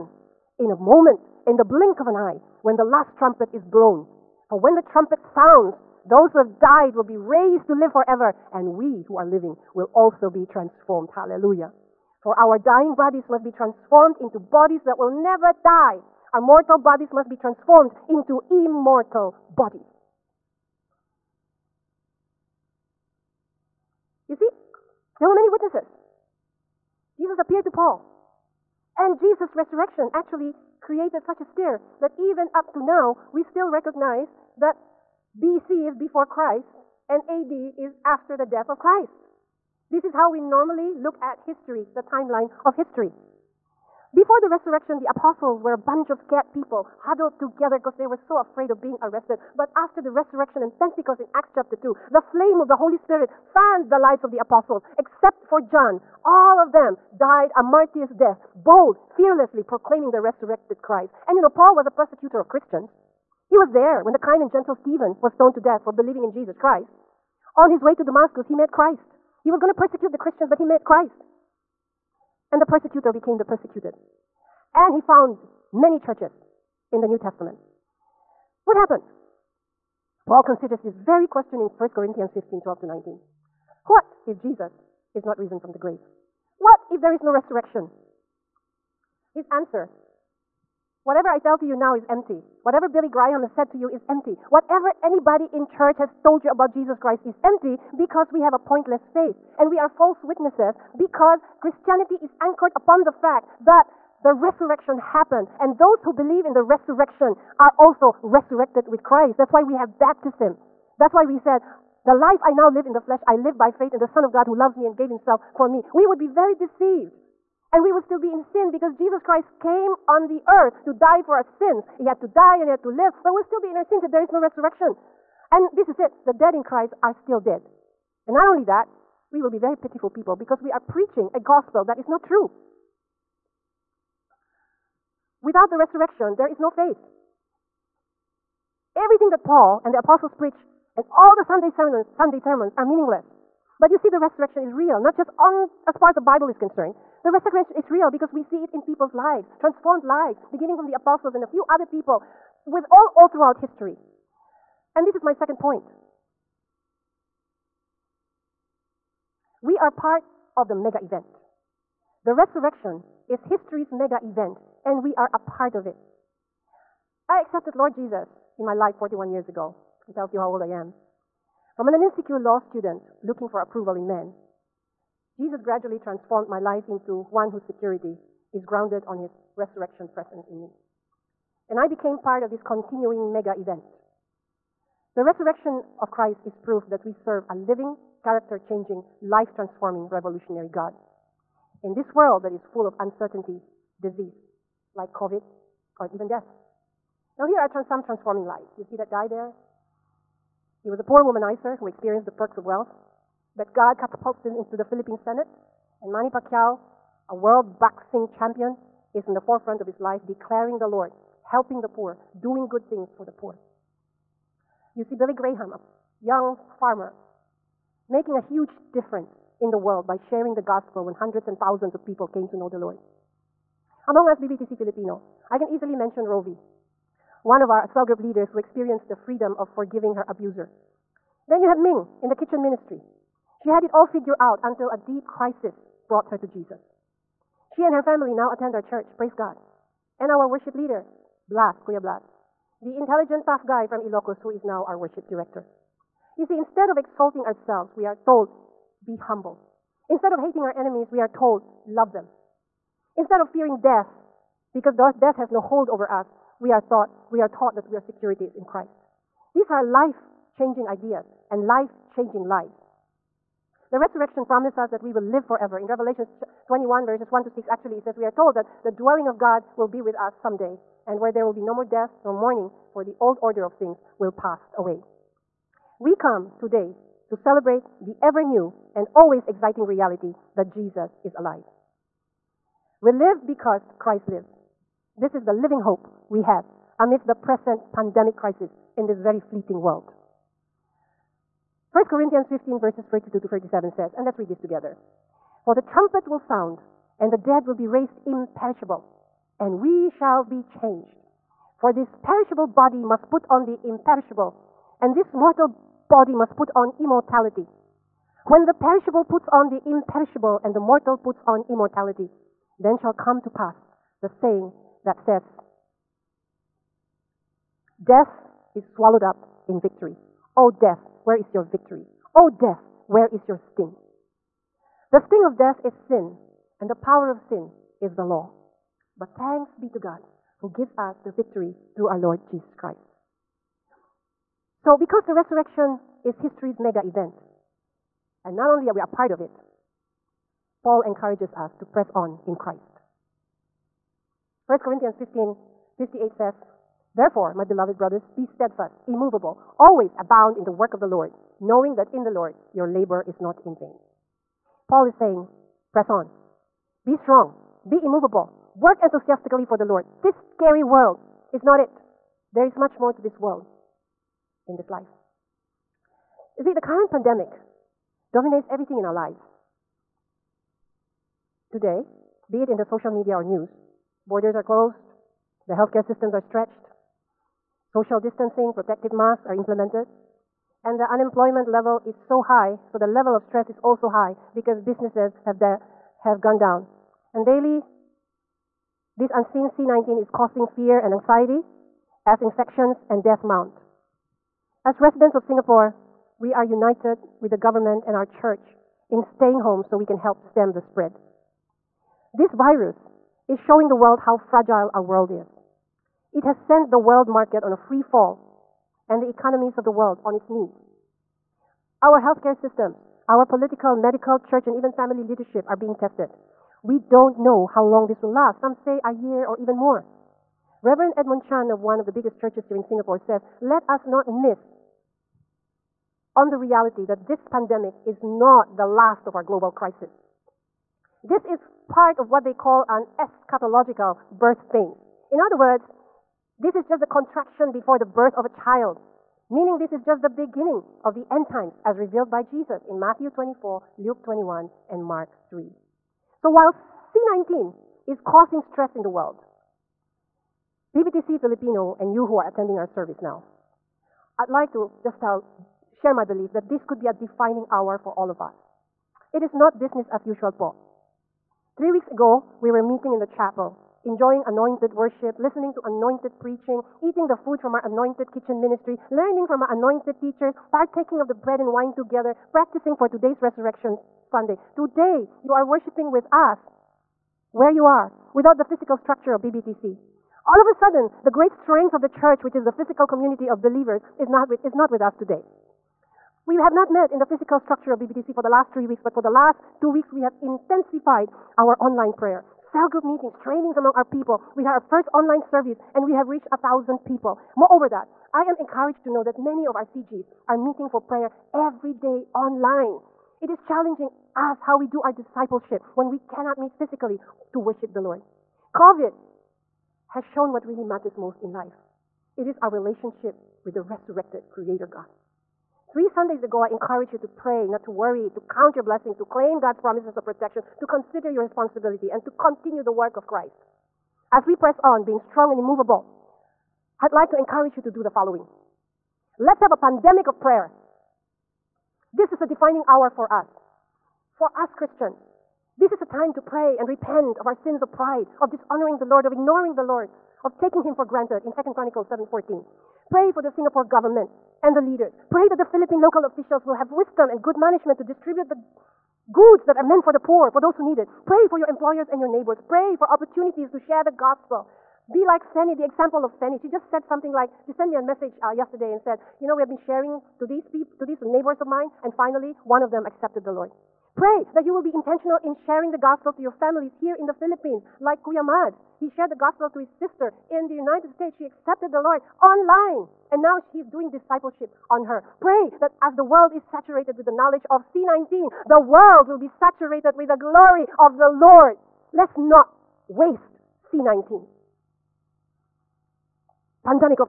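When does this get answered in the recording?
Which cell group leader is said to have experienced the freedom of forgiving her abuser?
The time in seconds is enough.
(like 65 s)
226 s.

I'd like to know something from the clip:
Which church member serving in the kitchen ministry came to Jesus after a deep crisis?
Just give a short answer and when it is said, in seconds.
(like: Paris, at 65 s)
Ming, at 231 s.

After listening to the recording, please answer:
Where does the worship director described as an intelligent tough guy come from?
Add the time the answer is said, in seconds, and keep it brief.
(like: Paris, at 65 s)
Ilocos, at 244 s.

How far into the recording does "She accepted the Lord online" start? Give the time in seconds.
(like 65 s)
571 s.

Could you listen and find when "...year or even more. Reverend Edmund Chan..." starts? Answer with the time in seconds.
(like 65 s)
419 s.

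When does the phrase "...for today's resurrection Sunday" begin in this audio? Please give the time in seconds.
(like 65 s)
472 s.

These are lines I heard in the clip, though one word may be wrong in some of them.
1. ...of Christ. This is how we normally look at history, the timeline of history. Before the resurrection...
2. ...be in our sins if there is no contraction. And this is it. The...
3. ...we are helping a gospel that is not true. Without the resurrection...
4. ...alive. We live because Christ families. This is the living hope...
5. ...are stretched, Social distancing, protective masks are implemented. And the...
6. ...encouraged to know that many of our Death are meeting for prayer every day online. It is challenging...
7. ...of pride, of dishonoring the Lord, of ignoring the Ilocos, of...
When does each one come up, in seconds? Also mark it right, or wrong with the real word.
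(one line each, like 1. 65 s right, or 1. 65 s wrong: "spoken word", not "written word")
1. 38 s right
2. 123 s wrong: "resurrection", not "contraction"
3. 130 s wrong: "preaching", not "helping"
4. 281 s wrong: "lives", not "families"
5. 376 s right
6. 498 s wrong: "CGs", not "Death"
7. 537 s wrong: "Lord", not "Ilocos".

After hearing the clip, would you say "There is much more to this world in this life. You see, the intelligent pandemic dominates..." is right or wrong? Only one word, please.
wrong.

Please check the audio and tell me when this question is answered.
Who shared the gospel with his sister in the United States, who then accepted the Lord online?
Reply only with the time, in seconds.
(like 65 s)
568 s.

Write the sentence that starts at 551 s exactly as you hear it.
Pray for your employers and your neighbors.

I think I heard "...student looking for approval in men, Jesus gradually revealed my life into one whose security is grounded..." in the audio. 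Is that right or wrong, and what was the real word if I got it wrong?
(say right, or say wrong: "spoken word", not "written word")
wrong: "transformed", not "revealed".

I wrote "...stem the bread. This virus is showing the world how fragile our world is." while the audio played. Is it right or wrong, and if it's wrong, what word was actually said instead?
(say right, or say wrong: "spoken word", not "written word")
wrong: "spread", not "bread".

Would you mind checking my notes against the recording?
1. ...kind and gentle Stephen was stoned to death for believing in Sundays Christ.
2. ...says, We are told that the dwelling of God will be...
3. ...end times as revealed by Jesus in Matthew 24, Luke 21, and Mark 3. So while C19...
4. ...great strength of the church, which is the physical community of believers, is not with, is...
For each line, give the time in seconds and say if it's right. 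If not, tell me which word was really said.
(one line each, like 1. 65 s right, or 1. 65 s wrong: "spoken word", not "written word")
1. 64 s wrong: "Jesus", not "Sundays"
2. 268 s right
3. 441 s right
4. 481 s right.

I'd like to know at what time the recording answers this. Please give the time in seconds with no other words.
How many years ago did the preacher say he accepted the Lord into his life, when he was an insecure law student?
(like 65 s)
168 s.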